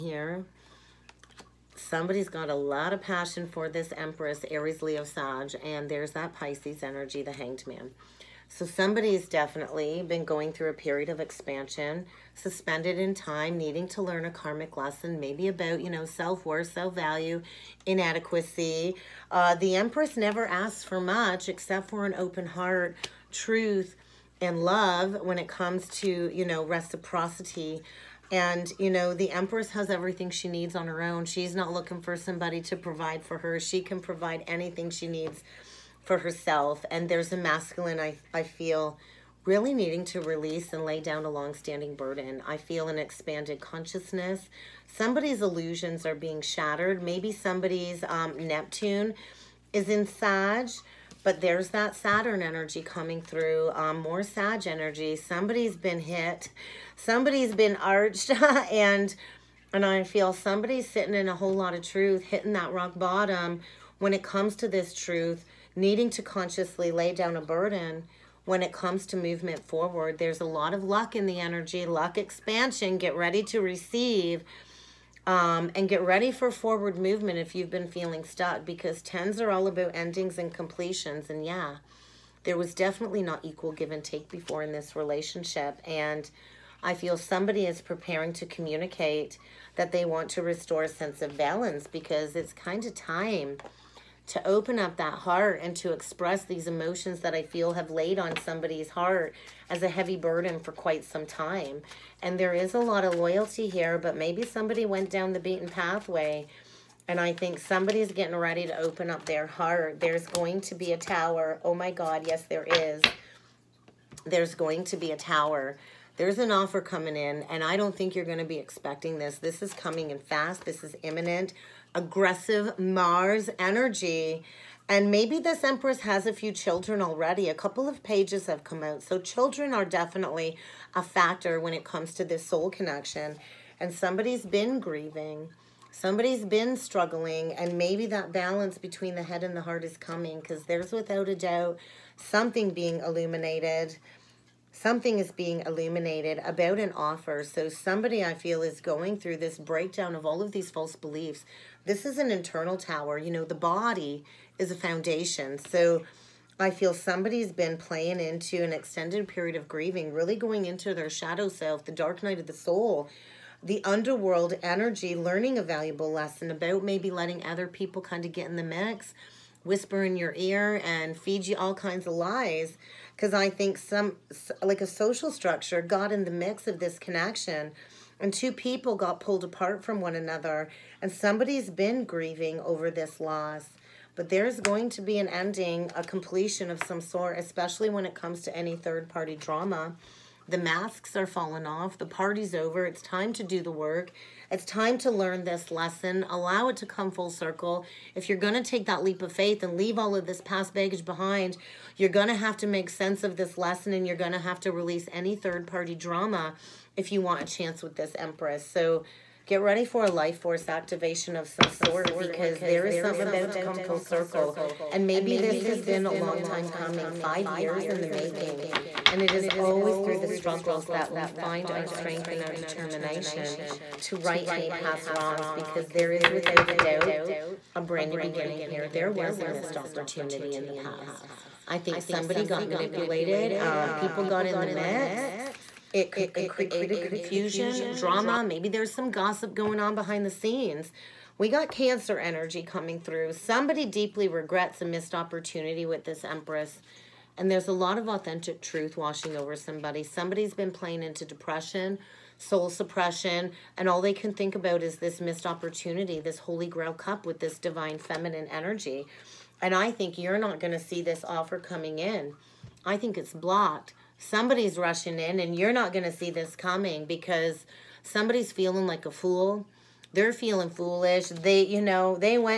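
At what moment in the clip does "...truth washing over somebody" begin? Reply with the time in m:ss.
4:08.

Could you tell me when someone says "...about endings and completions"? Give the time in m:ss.
1:19.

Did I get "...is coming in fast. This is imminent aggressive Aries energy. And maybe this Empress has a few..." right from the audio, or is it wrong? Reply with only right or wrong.
wrong.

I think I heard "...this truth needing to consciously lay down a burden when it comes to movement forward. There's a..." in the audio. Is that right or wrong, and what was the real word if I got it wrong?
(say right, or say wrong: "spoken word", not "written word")
right.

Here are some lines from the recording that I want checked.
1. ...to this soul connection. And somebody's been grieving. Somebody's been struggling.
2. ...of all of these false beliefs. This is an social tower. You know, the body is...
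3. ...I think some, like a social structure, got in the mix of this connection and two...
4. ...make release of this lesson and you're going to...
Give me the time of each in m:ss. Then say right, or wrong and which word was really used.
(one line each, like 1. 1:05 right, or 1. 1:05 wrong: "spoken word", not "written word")
1. 2:12 right
2. 2:30 wrong: "internal", not "social"
3. 2:53 right
4. 3:22 wrong: "sense", not "release".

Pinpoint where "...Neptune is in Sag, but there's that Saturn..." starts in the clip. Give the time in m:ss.
0:48.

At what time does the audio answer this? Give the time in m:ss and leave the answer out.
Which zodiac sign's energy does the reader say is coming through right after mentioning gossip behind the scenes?
4:01.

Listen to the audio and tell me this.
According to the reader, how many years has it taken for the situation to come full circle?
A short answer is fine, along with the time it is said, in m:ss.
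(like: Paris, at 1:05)
5, at 3:37.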